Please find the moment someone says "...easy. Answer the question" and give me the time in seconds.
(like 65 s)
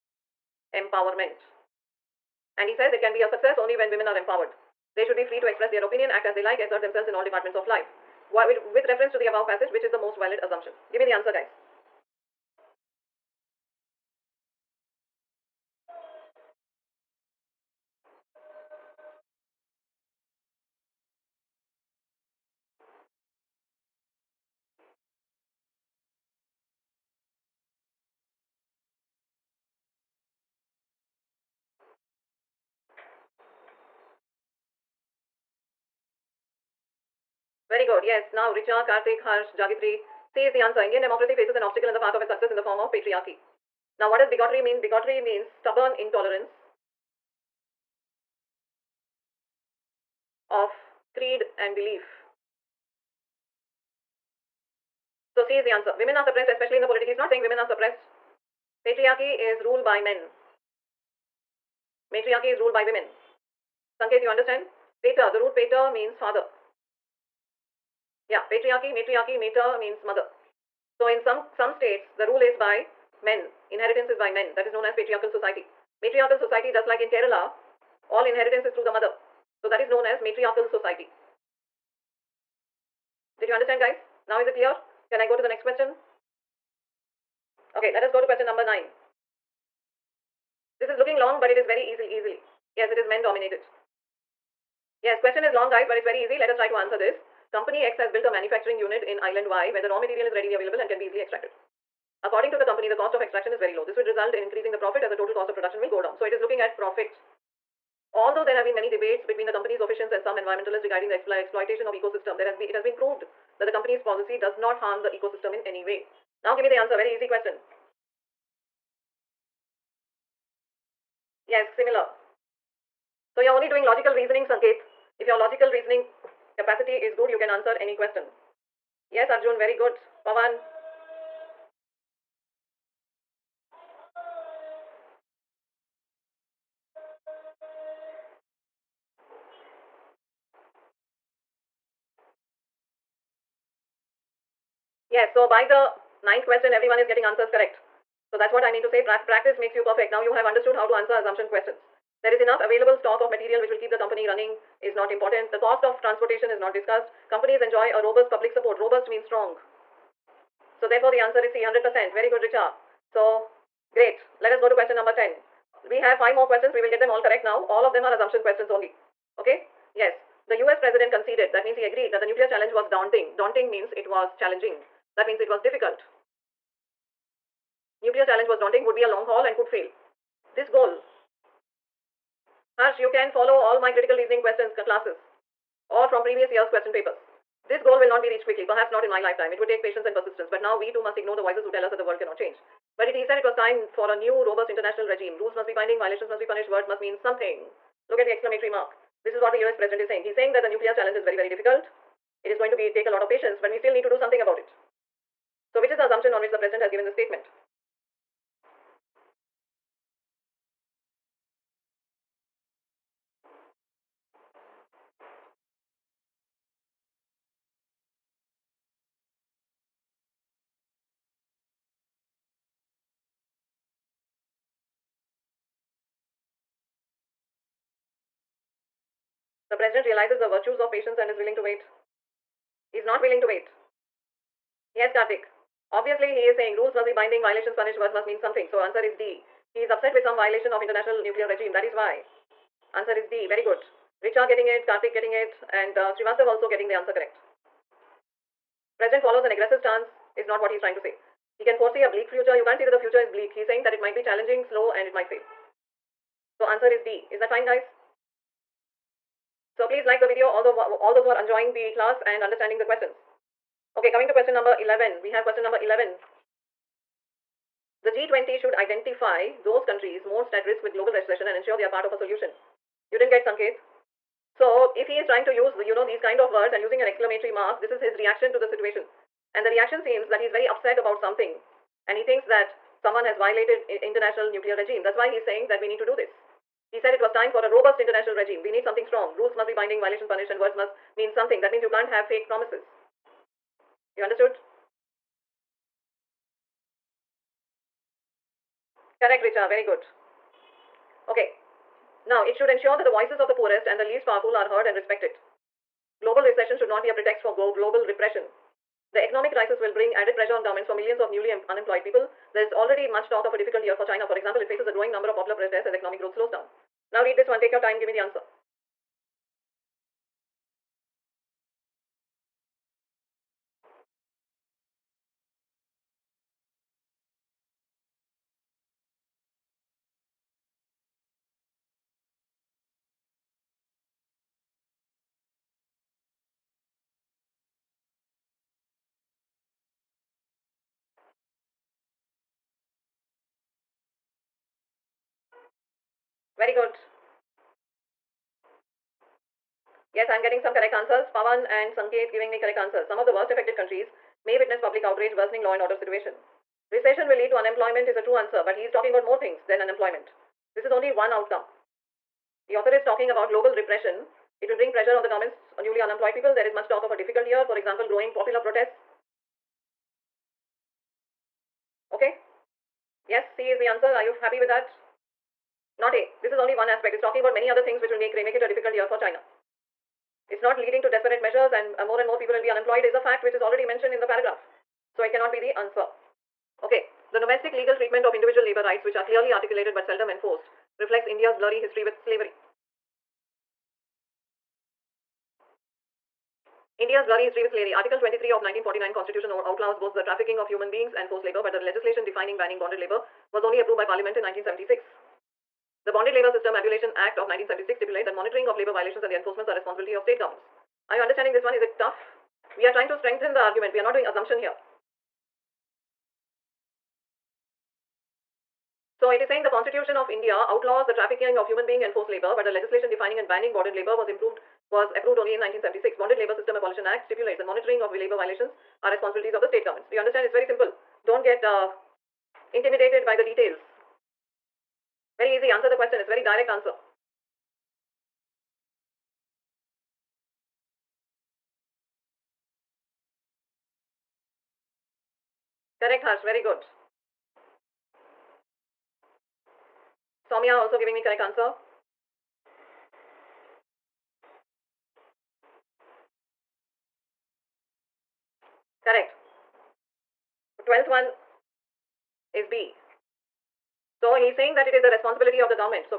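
435 s.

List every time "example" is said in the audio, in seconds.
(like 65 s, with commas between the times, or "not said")
314 s, 367 s.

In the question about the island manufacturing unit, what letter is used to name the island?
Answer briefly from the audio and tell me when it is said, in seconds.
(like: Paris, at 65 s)
Y, at 99 s.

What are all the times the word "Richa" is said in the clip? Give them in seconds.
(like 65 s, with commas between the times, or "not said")
38 s, 162 s, 244 s, 299 s.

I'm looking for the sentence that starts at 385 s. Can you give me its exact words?
So it cannot be the answer.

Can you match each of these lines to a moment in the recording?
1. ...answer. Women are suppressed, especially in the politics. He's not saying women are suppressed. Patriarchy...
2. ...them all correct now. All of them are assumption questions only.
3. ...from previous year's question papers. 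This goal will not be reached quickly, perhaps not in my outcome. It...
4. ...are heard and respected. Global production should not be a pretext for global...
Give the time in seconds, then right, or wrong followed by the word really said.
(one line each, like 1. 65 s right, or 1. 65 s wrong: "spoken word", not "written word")
1. 55 s right
2. 166 s right
3. 186 s wrong: "lifetime", not "outcome"
4. 304 s wrong: "recession", not "production".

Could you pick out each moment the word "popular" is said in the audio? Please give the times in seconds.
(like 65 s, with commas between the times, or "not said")
315 s, 368 s.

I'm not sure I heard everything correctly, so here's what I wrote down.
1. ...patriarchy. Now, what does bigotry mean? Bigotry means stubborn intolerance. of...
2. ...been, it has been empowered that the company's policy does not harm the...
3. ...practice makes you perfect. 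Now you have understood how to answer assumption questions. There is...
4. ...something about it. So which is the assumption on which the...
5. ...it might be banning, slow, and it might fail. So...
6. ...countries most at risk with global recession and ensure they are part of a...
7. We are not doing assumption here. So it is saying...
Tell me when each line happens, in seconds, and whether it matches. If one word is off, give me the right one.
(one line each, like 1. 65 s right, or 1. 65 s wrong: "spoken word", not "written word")
1. 42 s right
2. 112 s wrong: "proved", not "empowered"
3. 149 s right
4. 204 s right
5. 253 s wrong: "challenging", not "banning"
6. 269 s right
7. 413 s right.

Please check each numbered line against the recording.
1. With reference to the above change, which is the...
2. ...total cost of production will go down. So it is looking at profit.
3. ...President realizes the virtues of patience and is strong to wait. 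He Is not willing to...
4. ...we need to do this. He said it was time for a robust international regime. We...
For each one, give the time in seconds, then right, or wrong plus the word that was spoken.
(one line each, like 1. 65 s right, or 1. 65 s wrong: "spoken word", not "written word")
1. 8 s wrong: "passage", not "change"
2. 105 s right
3. 229 s wrong: "willing", not "strong"
4. 285 s right.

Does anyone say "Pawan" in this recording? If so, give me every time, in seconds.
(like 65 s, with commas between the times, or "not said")
130 s, 351 s.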